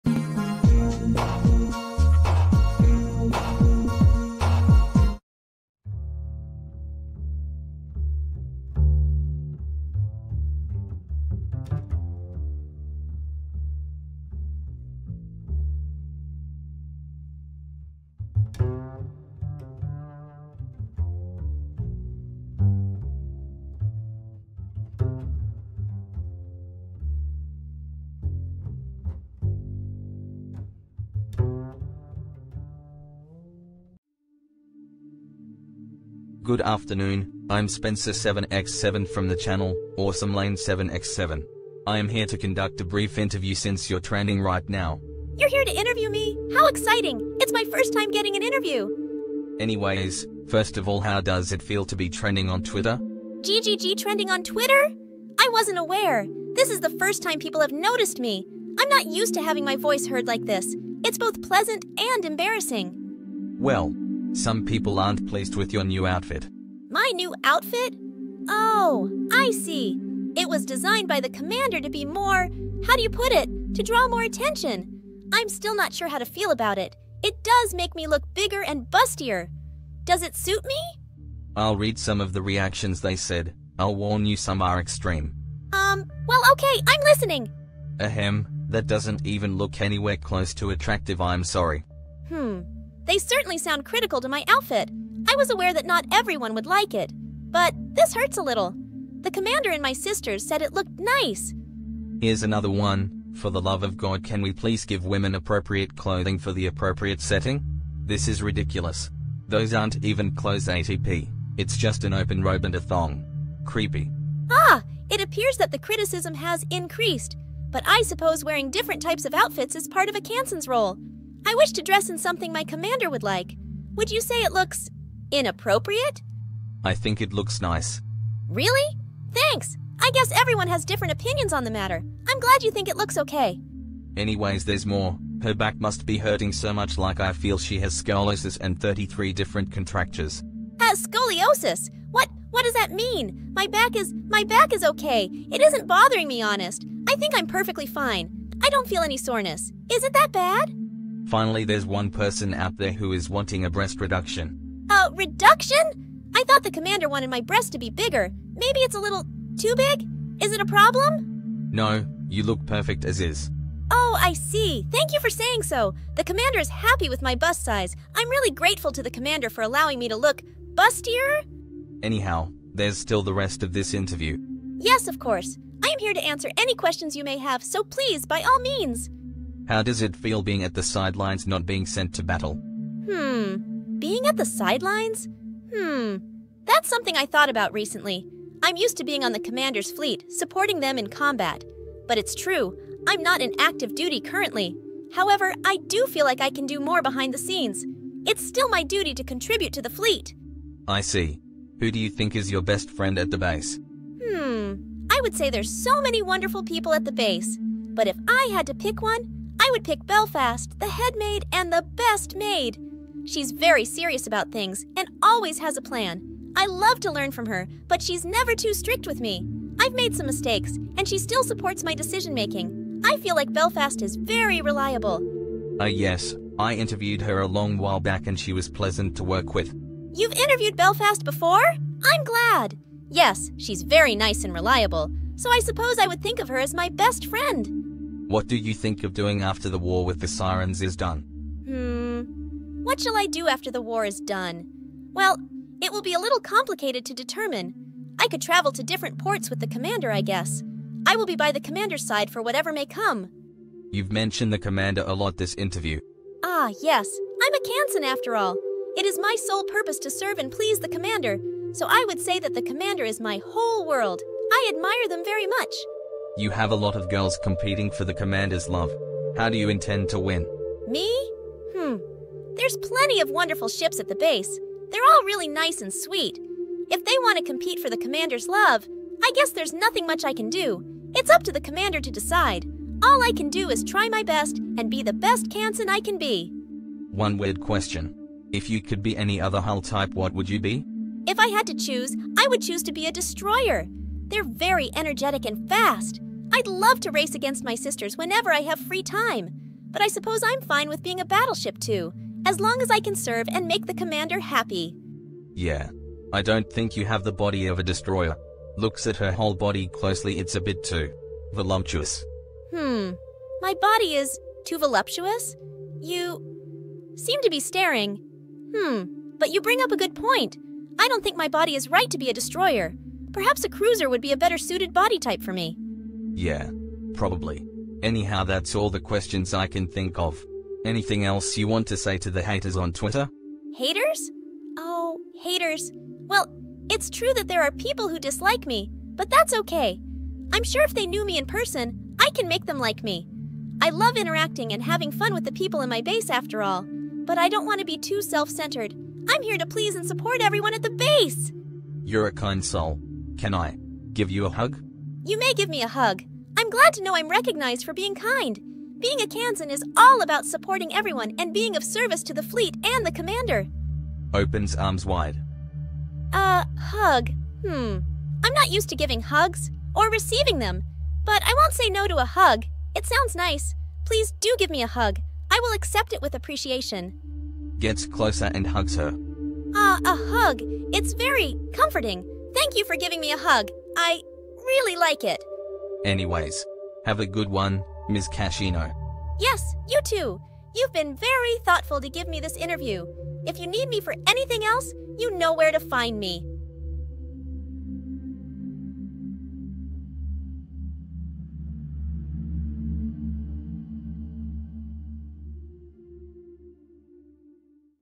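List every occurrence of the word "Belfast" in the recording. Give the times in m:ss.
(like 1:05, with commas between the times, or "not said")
3:30, 3:43, 3:50.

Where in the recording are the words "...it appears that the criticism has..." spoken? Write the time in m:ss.
1:55.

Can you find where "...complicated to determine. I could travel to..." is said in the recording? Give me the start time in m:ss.
4:06.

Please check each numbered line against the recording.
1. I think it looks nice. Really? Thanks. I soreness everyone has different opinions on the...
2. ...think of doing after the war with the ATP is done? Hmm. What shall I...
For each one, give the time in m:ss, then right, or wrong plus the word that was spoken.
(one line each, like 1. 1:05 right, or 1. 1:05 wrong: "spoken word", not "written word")
1. 2:06 wrong: "guess", not "soreness"
2. 3:58 wrong: "Sirens", not "ATP".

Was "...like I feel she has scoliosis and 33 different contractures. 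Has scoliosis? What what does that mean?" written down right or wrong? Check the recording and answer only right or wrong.
right.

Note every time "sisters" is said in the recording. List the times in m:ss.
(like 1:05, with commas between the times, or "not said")
1:39, 4:57.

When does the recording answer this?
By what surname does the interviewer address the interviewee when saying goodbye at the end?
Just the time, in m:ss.
6:28.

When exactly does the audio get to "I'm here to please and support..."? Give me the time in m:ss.
5:49.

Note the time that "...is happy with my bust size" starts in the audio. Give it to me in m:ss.
2:46.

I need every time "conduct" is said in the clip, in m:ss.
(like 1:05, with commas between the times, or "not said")
0:42.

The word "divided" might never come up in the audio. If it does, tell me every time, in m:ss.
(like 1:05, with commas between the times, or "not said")
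not said.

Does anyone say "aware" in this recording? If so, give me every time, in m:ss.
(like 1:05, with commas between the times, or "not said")
0:55, 1:35.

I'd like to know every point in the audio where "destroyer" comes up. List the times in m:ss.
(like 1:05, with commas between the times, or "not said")
4:53, 5:07, 5:22.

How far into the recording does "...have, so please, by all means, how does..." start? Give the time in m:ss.
2:57.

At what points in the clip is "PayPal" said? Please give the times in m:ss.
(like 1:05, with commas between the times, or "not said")
not said.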